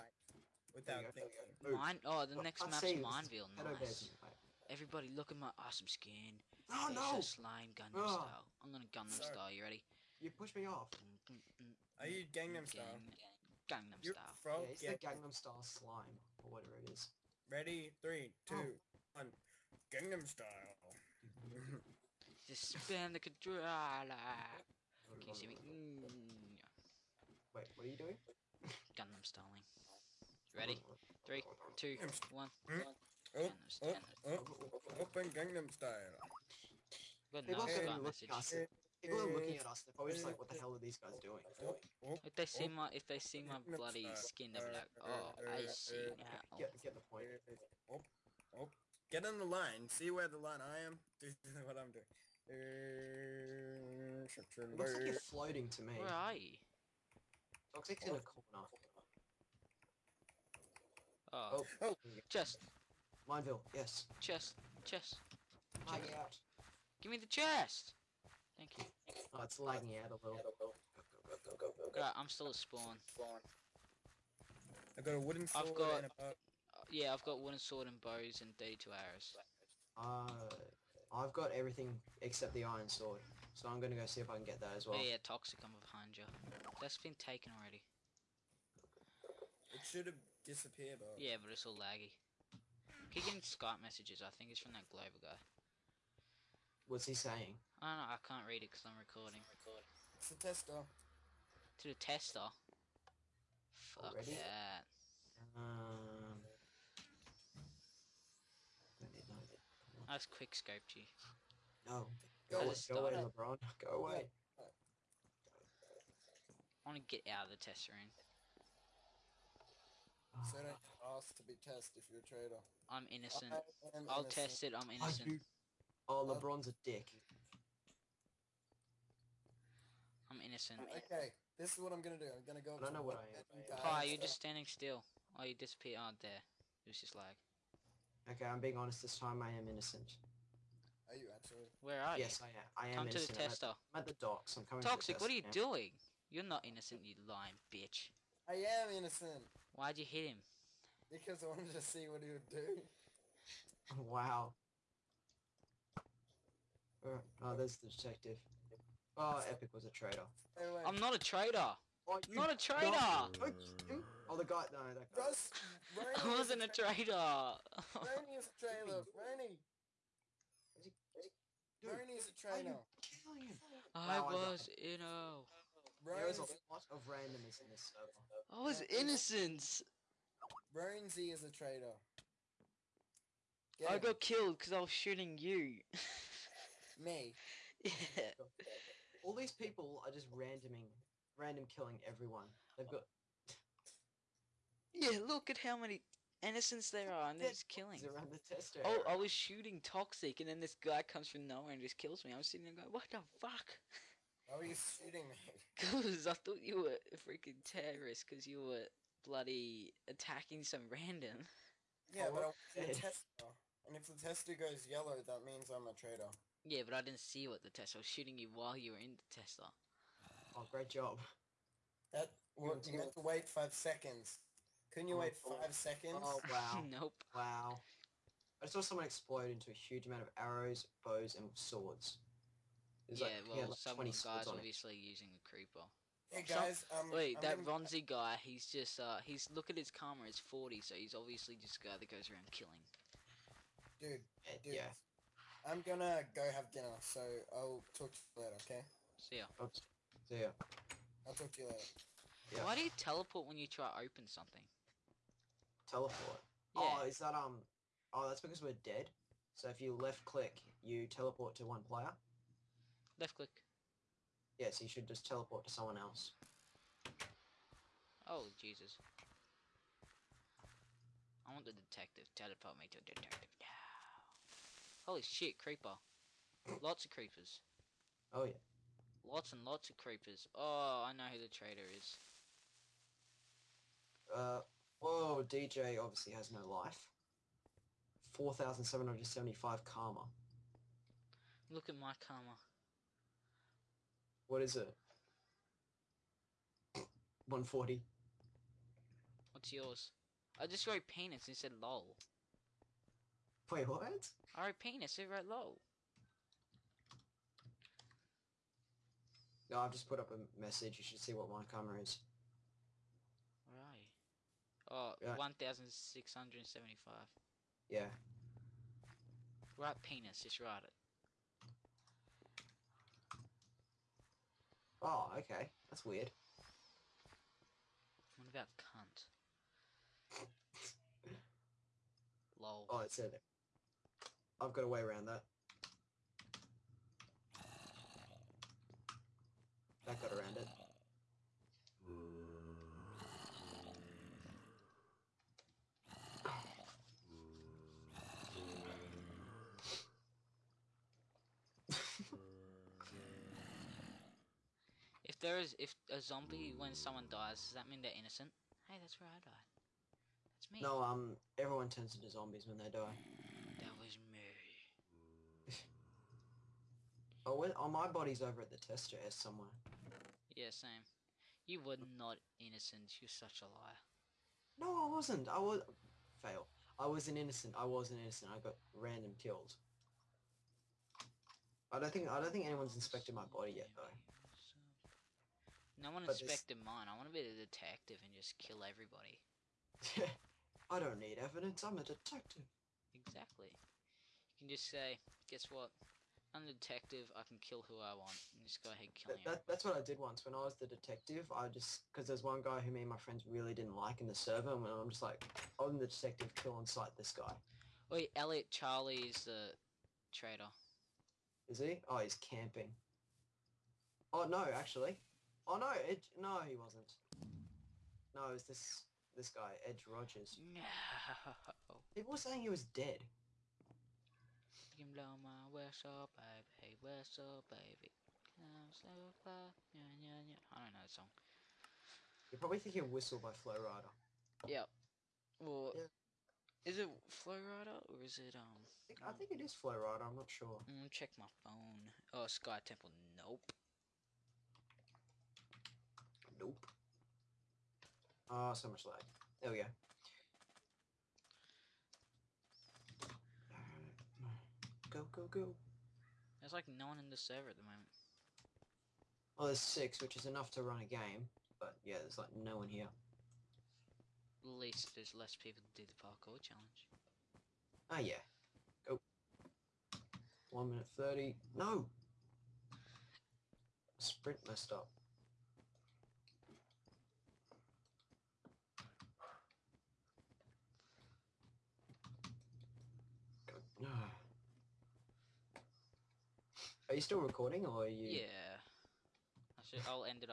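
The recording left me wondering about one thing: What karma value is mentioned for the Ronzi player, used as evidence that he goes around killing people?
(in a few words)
40.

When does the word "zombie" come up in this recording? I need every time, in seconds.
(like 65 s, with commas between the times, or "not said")
356 s, 362 s.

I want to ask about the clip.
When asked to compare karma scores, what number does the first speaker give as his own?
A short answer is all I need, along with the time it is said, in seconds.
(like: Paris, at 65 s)
140, at 297 s.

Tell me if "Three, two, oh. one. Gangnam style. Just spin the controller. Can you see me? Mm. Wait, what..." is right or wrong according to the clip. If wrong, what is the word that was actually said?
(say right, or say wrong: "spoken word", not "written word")
right.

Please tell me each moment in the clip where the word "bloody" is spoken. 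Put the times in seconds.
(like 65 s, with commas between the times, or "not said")
43 s, 209 s.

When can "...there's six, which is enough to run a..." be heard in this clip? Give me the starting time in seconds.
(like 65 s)
459 s.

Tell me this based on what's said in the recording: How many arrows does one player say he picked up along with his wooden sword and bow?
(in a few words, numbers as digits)
32.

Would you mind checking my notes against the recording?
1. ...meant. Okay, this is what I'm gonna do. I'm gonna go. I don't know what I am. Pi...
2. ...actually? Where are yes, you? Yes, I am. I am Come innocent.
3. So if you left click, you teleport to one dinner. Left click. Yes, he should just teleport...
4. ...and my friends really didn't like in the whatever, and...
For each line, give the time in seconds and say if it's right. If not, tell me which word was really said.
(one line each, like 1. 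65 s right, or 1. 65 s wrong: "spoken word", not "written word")
1. 130 s wrong: "innocent", not "meant"
2. 141 s right
3. 259 s wrong: "player", not "dinner"
4. 403 s wrong: "server", not "whatever".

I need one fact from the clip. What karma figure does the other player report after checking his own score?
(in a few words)
1,675.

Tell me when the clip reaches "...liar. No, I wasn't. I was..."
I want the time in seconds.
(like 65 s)
373 s.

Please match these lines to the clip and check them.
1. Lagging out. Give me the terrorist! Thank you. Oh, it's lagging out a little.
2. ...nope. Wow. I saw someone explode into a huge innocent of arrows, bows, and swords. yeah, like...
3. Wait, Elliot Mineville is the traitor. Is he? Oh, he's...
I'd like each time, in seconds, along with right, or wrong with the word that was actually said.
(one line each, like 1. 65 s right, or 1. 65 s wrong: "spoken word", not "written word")
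1. 65 s wrong: "chest", not "terrorist"
2. 226 s wrong: "amount", not "innocent"
3. 408 s wrong: "Charlie", not "Mineville".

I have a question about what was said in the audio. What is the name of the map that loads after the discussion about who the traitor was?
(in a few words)
Sky Temple.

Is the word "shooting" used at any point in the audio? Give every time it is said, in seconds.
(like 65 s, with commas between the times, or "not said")
184 s, 199 s, 204 s, 218 s.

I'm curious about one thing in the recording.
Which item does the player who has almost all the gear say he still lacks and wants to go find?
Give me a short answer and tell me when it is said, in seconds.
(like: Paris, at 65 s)
iron sword, at 82 s.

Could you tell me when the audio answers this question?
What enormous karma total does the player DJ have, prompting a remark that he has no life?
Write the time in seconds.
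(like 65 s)
288 s.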